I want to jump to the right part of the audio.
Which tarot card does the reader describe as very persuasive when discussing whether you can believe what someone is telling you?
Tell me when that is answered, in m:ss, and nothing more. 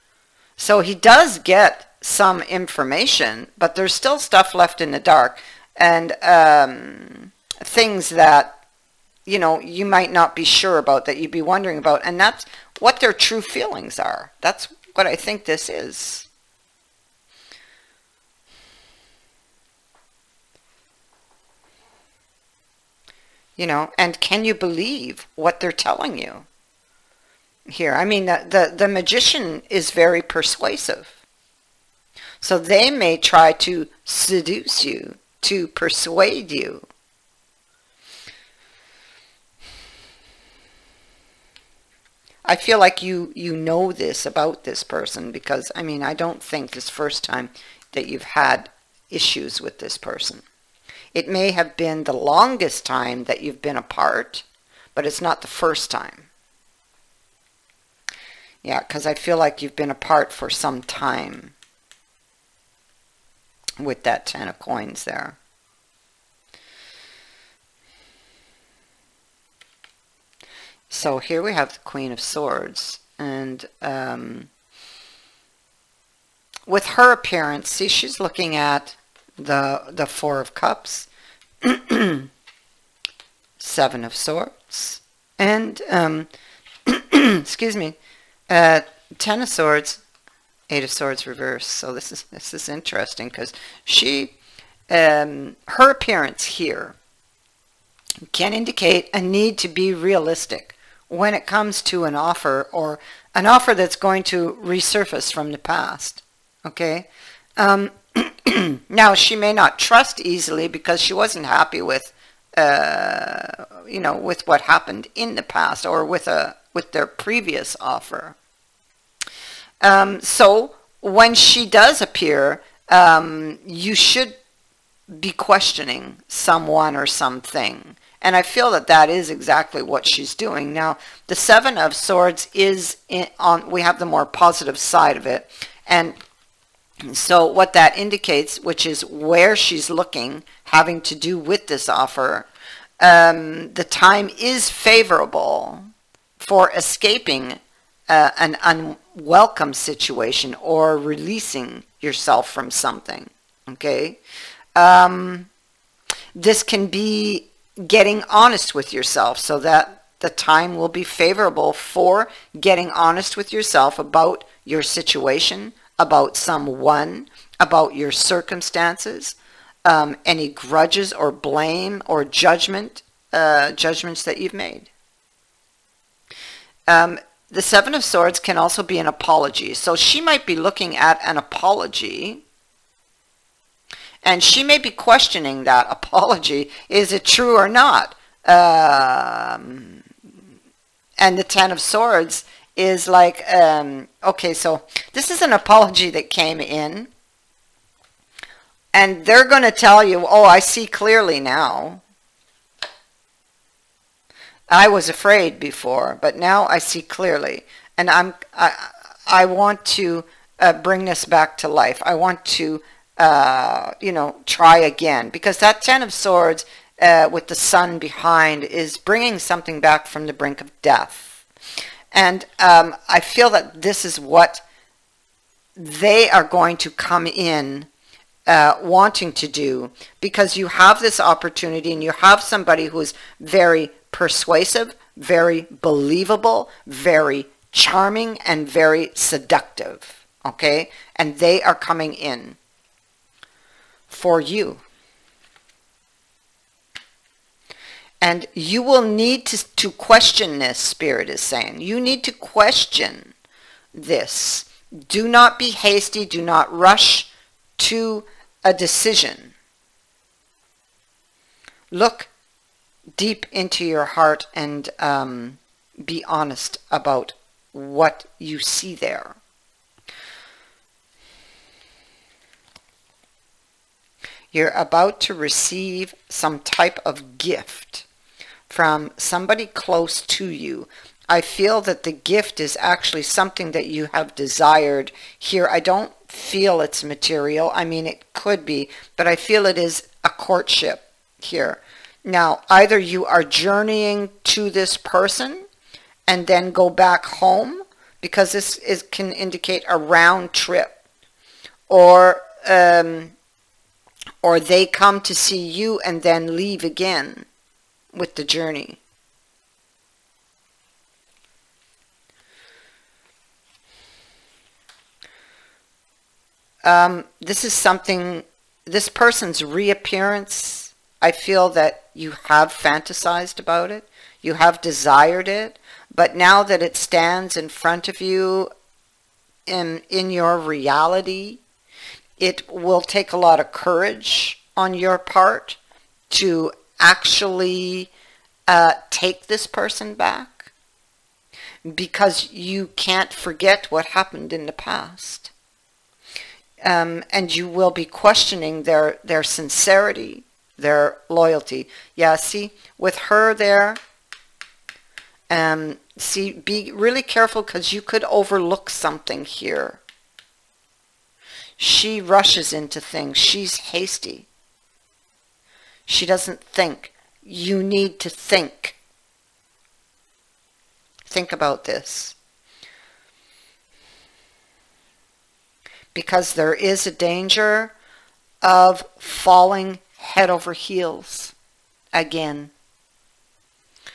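0:28.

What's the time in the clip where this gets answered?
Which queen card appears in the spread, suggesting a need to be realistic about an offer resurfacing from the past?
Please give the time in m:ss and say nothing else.
1:11.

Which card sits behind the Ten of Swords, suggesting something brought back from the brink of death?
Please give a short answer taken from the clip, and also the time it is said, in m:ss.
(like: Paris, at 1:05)
The Sun, at 3:37.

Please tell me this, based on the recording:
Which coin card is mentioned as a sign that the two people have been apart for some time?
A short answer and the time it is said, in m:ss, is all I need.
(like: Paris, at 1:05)
Ten of Coins, at 1:04.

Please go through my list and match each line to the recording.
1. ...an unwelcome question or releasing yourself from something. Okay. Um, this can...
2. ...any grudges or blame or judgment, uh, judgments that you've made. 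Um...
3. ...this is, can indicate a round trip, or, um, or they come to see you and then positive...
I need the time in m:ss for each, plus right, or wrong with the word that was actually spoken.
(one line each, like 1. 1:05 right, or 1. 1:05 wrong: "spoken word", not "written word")
1. 2:28 wrong: "situation", not "question"
2. 2:50 right
3. 4:58 wrong: "leave", not "positive".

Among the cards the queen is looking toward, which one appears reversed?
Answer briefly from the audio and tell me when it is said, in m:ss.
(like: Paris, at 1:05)
Eight of Swords, at 1:30.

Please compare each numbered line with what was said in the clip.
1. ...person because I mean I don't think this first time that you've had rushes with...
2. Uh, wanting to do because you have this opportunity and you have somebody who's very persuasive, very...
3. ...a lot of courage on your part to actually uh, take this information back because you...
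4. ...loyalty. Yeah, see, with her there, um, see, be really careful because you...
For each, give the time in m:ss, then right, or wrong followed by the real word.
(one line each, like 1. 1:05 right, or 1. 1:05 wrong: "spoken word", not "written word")
1. 0:44 wrong: "issues", not "rushes"
2. 3:48 right
3. 5:33 wrong: "person", not "information"
4. 5:51 right.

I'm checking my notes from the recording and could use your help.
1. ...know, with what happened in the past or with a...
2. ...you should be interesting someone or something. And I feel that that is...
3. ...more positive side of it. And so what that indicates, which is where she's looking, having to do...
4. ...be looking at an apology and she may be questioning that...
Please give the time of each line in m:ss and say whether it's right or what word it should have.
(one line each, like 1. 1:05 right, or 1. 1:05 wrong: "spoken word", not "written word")
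1. 1:53 right
2. 2:03 wrong: "questioning", not "interesting"
3. 2:14 right
4. 3:00 right.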